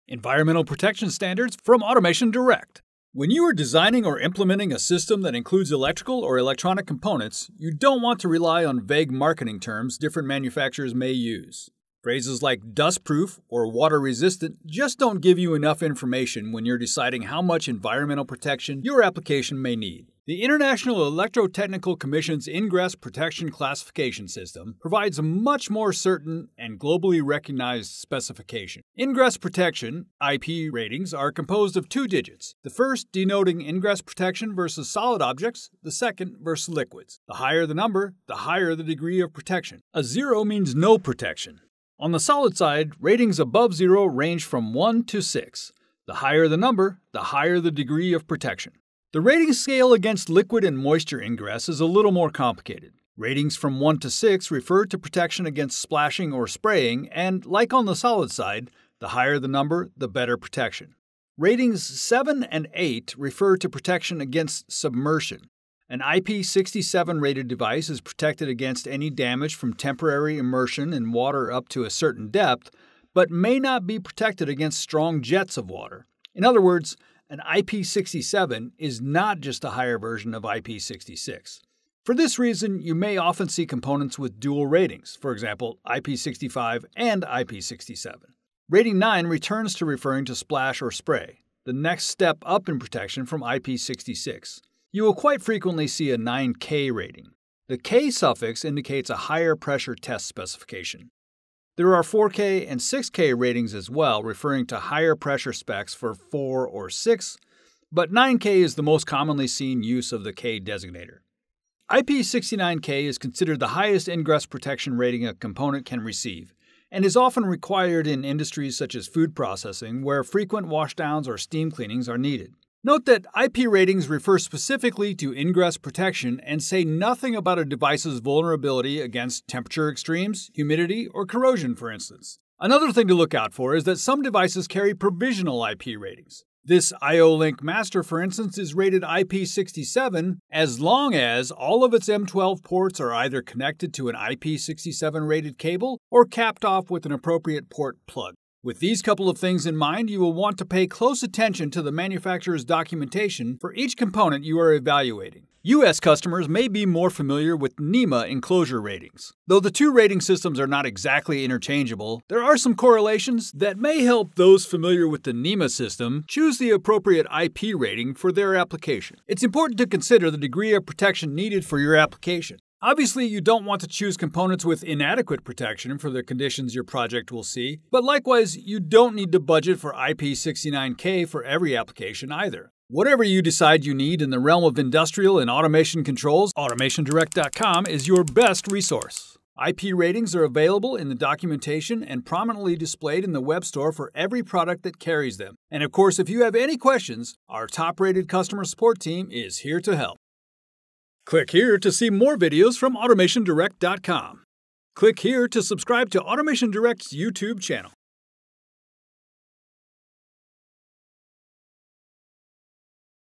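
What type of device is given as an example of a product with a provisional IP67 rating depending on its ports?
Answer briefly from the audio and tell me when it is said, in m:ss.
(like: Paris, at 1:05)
IO-Link Master, at 2:17.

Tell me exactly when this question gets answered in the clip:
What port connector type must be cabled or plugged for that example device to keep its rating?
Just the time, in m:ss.
2:22.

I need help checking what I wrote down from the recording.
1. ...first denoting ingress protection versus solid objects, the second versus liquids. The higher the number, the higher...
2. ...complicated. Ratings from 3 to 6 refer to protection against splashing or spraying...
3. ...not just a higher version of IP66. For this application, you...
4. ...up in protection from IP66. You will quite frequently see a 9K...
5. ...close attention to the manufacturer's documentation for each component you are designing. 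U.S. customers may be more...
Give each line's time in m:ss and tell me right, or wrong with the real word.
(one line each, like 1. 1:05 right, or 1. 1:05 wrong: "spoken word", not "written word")
1. 0:32 right
2. 0:52 wrong: "1", not "3"
3. 1:18 wrong: "reason", not "application"
4. 1:32 right
5. 2:30 wrong: "evaluating", not "designing".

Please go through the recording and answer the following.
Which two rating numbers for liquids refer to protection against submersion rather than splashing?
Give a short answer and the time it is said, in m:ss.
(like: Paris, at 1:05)
7 and 8, at 1:01.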